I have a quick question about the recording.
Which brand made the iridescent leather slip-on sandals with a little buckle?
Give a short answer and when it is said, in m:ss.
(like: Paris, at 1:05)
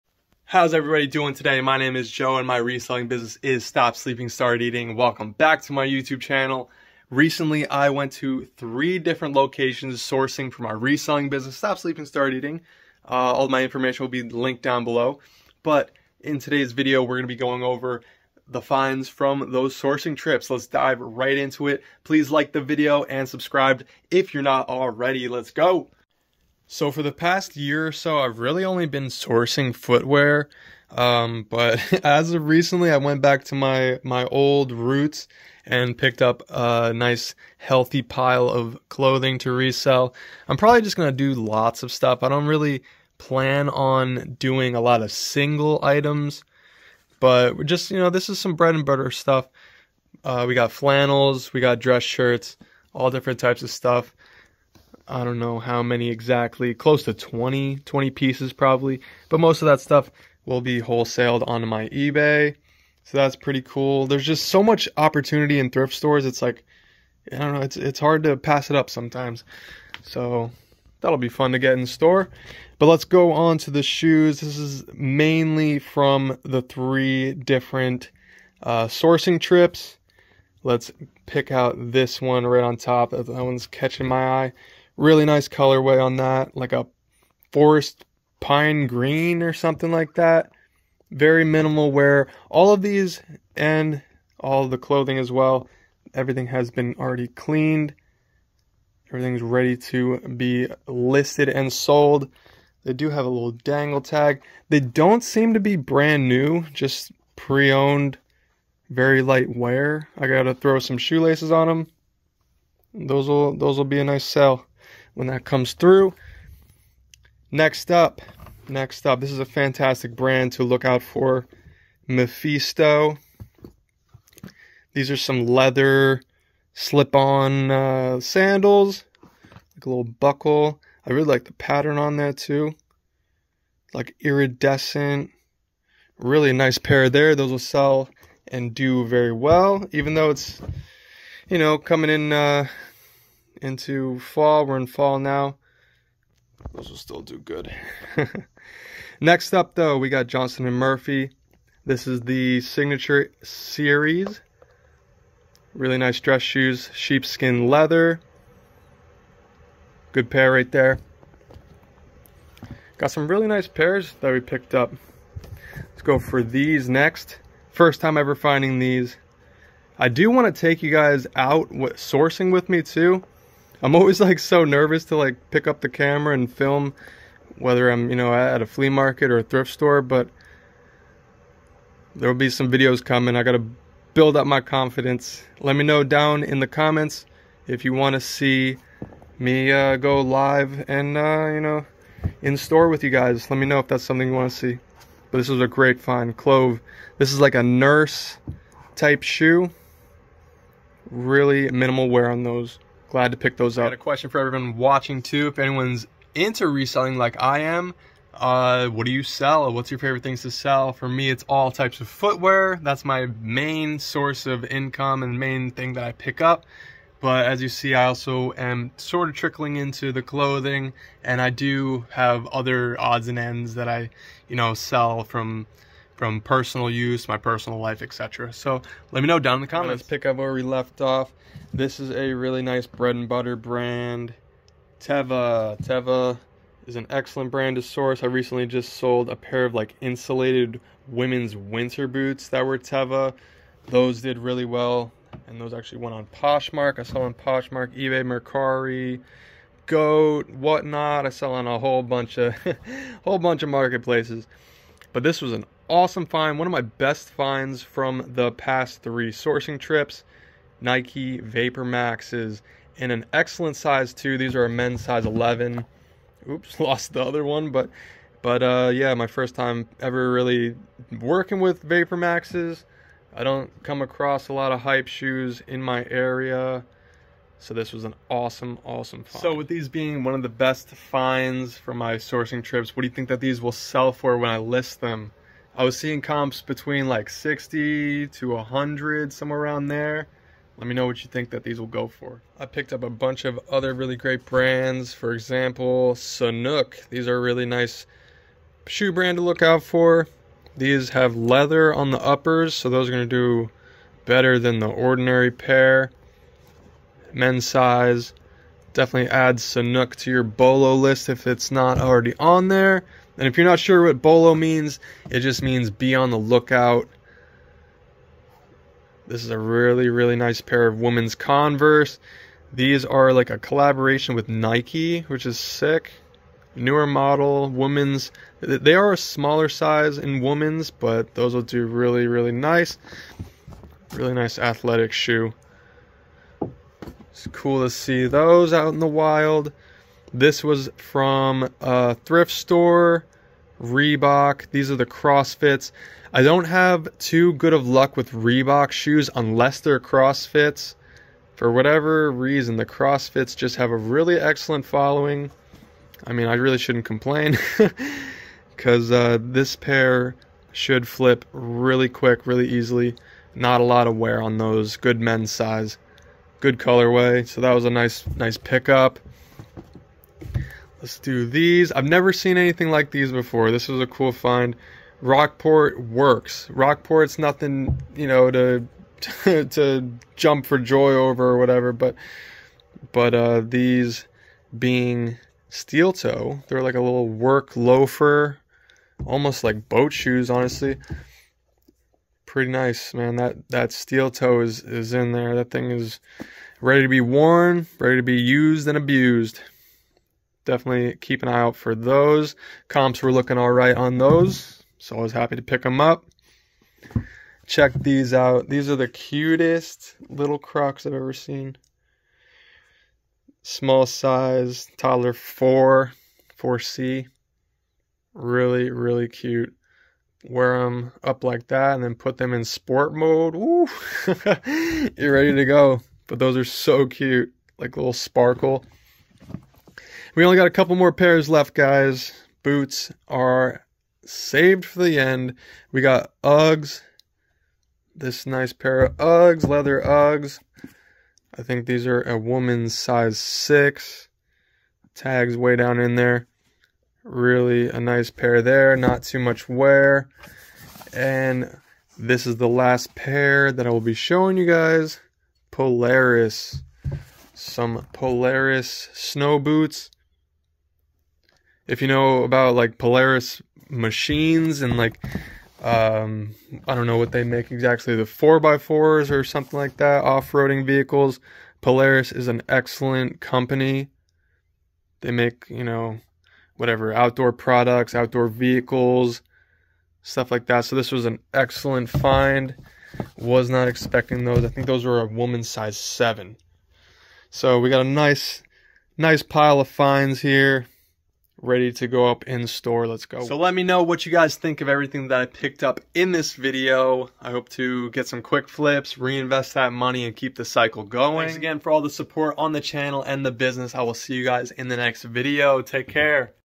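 Mephisto, at 2:02.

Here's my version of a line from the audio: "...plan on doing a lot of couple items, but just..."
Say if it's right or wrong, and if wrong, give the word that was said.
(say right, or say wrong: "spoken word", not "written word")
wrong: "single", not "couple".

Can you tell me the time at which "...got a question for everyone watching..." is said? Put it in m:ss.
3:23.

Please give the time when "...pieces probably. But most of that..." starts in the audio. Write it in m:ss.
0:58.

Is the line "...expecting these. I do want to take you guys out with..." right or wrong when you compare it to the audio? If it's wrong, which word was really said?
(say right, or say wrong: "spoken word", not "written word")
wrong: "finding", not "expecting".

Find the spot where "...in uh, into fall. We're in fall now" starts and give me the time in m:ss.
2:22.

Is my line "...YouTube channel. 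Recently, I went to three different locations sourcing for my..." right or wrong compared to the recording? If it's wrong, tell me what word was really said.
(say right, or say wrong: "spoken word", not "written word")
right.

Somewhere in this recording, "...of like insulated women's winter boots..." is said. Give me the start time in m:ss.
3:59.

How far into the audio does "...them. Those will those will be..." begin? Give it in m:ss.
1:51.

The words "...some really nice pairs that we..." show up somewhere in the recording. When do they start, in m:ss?
2:43.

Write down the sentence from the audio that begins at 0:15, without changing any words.
But in today's video, we're going to be going over the finds from those sourcing trips.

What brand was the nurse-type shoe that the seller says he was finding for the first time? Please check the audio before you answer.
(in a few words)
Clove.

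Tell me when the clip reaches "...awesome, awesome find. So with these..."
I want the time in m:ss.
4:38.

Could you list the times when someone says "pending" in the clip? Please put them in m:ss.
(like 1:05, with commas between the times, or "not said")
not said.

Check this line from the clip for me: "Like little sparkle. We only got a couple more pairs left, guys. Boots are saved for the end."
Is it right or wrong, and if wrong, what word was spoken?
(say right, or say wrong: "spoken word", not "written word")
right.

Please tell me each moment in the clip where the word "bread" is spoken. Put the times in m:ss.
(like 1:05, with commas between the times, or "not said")
0:48, 3:52.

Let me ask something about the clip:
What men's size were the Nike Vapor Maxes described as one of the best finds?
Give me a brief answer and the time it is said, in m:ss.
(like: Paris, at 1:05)
11, at 4:25.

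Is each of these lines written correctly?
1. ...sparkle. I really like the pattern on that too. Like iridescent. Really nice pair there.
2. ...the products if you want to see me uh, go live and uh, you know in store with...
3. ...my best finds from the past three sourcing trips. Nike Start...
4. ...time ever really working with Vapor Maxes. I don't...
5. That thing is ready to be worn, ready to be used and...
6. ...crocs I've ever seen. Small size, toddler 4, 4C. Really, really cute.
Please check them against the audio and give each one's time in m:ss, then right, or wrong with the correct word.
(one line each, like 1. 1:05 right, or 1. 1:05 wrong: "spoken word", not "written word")
1. 2:10 wrong: "buckle", not "sparkle"
2. 3:06 wrong: "comments", not "products"
3. 4:16 wrong: "Vapor", not "Start"
4. 4:29 right
5. 6:35 right
6. 6:50 right.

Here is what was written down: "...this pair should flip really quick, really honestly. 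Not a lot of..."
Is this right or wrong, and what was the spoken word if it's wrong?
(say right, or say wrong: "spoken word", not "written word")
wrong: "easily", not "honestly".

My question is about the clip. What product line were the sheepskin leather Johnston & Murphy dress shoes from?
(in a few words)
Signature Series.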